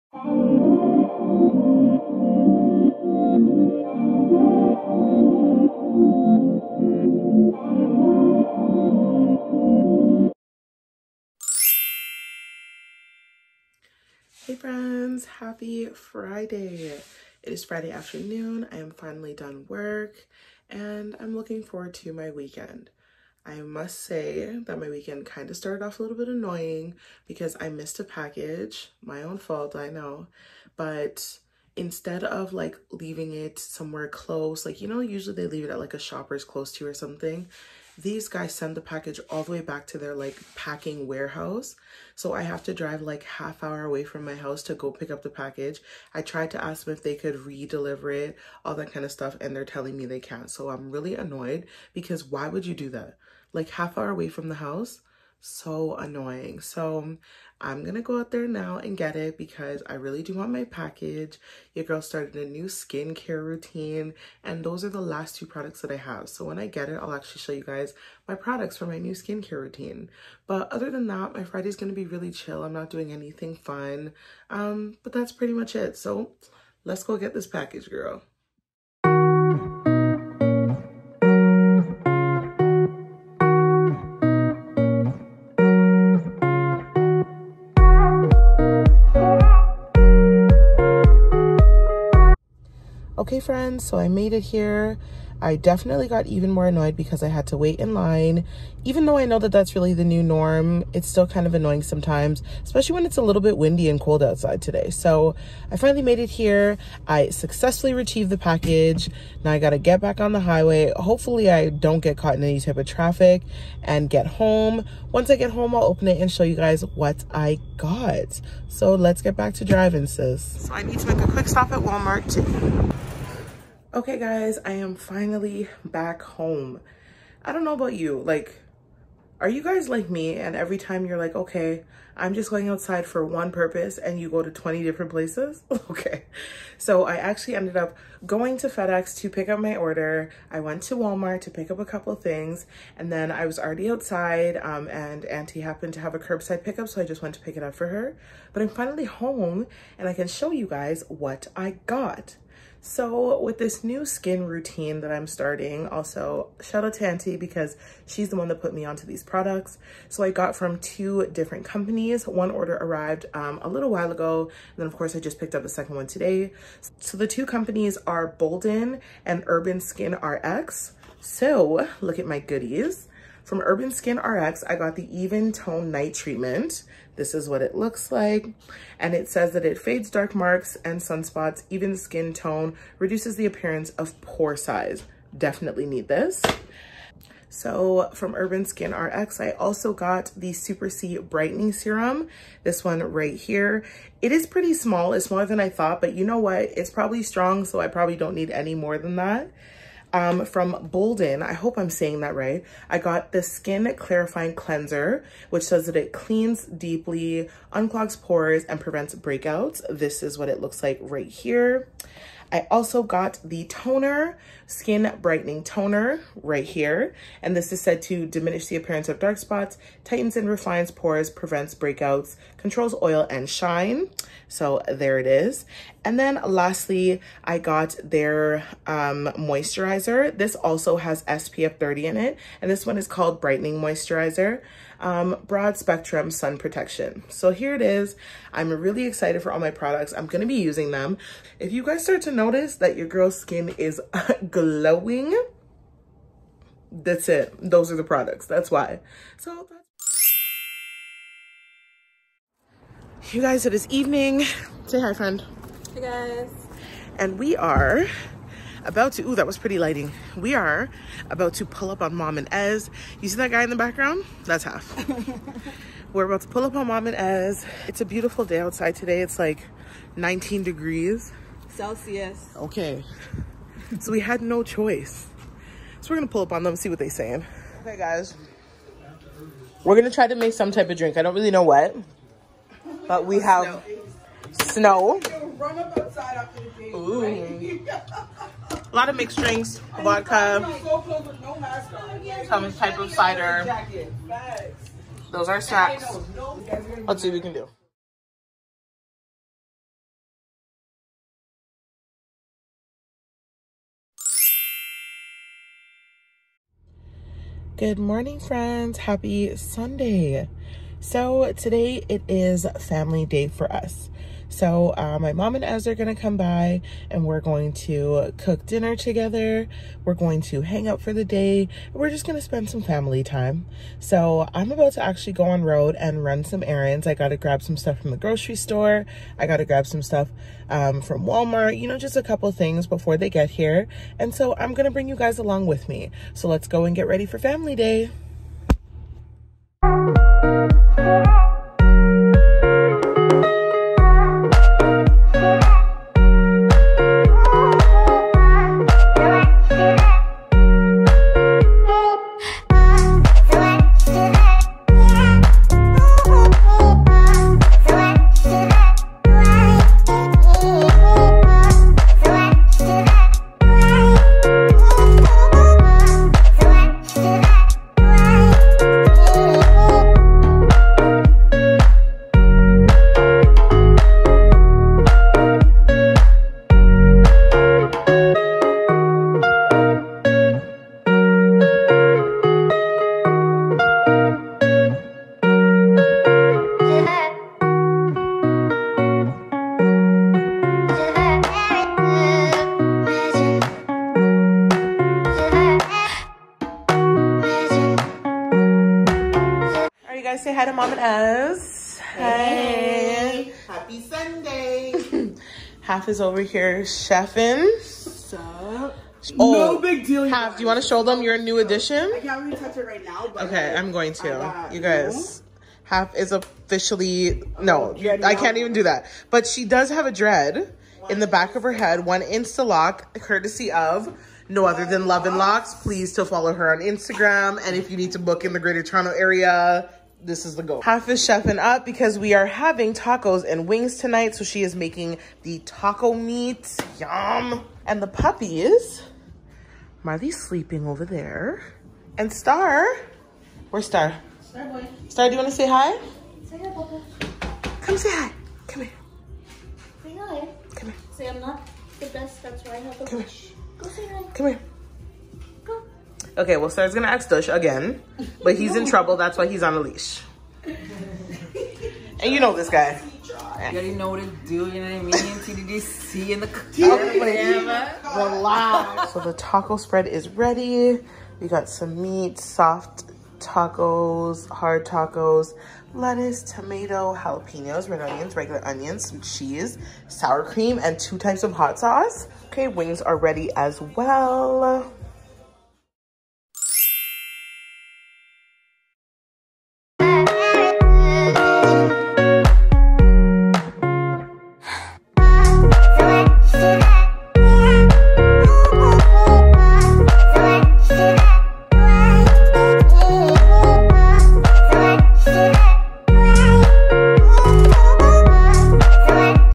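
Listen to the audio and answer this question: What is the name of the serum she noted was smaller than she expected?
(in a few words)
Super C Brightening Serum.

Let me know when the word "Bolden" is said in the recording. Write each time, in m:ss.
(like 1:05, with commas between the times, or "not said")
2:48, 3:20.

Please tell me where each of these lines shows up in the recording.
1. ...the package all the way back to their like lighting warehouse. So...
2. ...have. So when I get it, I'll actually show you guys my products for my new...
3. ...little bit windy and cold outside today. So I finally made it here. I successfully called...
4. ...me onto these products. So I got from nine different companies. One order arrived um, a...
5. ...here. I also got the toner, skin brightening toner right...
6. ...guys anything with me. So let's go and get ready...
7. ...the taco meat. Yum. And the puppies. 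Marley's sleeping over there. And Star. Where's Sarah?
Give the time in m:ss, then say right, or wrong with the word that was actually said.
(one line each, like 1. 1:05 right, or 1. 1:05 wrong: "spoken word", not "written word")
1. 0:38 wrong: "packing", not "lighting"
2. 1:05 right
3. 1:43 wrong: "retrieved", not "called"
4. 2:38 wrong: "two", not "nine"
5. 3:31 right
6. 5:35 wrong: "along", not "anything"
7. 7:15 wrong: "Star", not "Sarah".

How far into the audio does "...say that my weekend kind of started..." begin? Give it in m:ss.
0:23.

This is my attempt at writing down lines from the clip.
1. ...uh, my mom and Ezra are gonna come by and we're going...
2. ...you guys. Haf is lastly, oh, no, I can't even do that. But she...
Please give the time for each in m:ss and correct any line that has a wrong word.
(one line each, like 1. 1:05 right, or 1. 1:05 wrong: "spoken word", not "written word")
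1. 5:14 right
2. 6:54 wrong: "officially", not "lastly".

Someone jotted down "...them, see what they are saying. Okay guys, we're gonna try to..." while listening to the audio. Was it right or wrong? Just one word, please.
right.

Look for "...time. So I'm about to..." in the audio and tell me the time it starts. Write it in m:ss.
5:23.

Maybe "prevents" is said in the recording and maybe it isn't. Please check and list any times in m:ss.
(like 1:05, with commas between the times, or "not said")
3:28, 3:41.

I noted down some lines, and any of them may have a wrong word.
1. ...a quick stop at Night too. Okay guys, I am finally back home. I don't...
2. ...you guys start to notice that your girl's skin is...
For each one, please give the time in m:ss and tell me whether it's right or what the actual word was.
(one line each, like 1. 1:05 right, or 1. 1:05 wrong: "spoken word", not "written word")
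1. 2:01 wrong: "Walmart", not "Night"
2. 4:01 right.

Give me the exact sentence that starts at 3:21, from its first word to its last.
I hope I'm saying that right.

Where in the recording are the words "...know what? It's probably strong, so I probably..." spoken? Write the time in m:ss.
3:16.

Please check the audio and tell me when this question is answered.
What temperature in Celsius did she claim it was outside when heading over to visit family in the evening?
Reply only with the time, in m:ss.
4:30.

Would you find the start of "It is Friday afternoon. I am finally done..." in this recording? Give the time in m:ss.
0:16.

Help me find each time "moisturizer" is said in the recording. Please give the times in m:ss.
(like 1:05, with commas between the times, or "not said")
3:49, 3:53.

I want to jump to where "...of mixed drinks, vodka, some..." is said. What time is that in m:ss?
4:49.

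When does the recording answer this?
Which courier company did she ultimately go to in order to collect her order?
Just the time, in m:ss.
2:18.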